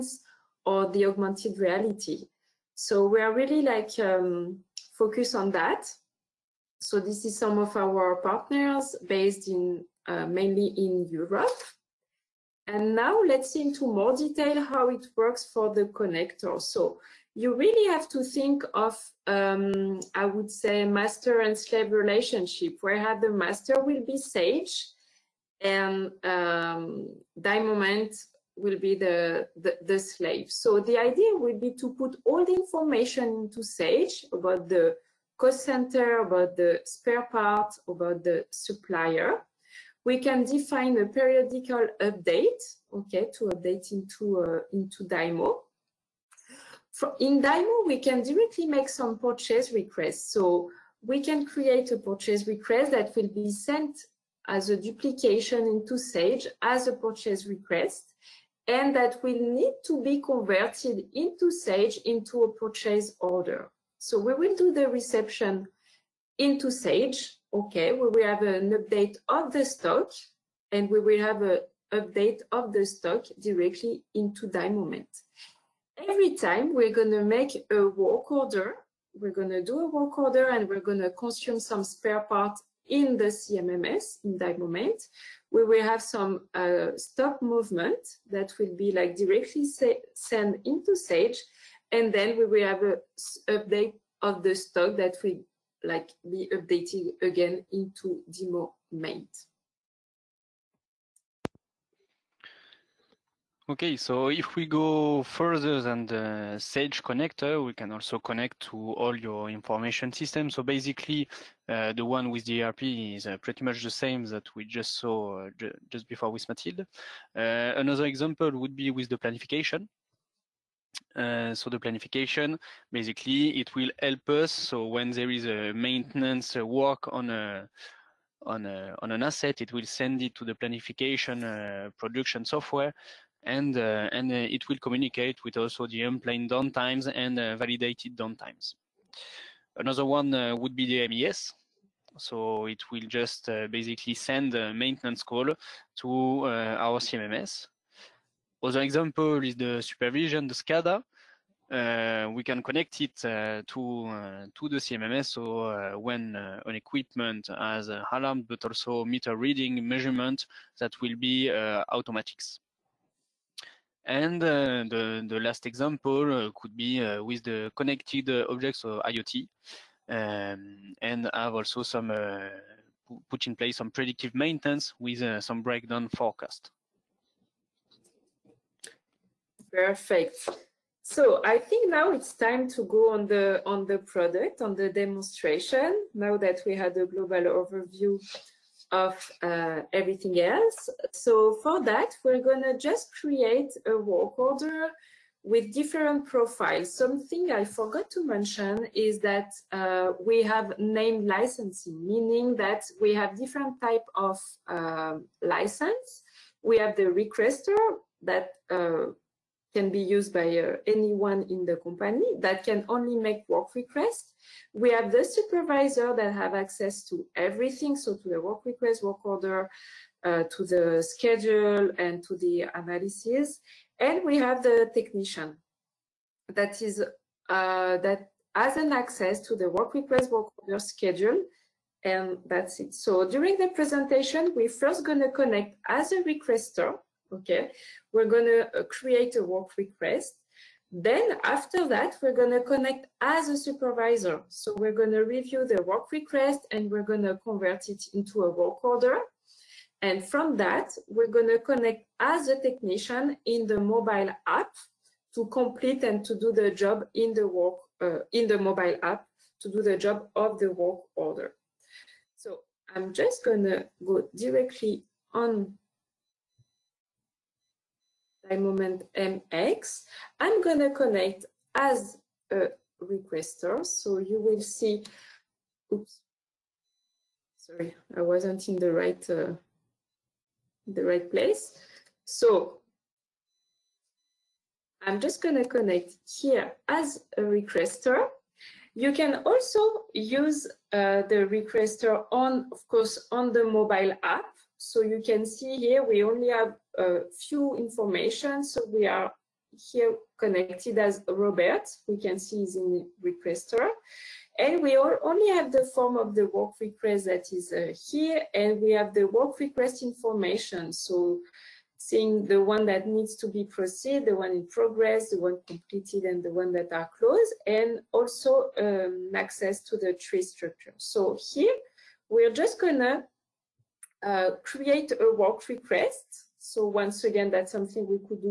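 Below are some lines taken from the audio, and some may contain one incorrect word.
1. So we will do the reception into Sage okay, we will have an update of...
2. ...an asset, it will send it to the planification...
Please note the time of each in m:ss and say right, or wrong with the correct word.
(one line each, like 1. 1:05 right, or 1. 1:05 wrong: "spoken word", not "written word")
1. 1:03 right
2. 2:09 right.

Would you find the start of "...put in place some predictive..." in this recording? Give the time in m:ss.
2:53.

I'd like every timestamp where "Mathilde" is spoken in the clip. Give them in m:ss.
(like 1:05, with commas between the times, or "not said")
1:56.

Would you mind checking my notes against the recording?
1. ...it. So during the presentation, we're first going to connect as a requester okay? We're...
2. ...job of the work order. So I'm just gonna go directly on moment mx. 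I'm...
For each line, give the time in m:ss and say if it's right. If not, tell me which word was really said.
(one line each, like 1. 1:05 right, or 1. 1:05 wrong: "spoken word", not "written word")
1. 3:52 right
2. 4:19 right.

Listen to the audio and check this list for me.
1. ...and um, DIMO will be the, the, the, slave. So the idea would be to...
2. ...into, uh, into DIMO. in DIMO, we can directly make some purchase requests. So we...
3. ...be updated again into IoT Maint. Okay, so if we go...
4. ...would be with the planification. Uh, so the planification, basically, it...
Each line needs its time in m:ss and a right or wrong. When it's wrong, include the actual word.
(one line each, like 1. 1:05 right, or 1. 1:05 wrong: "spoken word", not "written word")
1. 0:25 right
2. 0:43 right
3. 1:36 wrong: "DIMO", not "IoT"
4. 1:58 right.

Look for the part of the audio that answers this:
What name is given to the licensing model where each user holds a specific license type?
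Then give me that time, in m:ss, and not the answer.
3:20.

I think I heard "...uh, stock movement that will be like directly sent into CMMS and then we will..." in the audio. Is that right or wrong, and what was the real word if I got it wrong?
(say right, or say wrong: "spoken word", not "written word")
wrong: "Sage", not "CMMS".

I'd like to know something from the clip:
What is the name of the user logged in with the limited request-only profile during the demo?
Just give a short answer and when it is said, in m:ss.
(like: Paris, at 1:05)
Robert, at 5:01.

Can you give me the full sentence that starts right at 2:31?
Uh, we can connect it uh, to uh, to the CMMS.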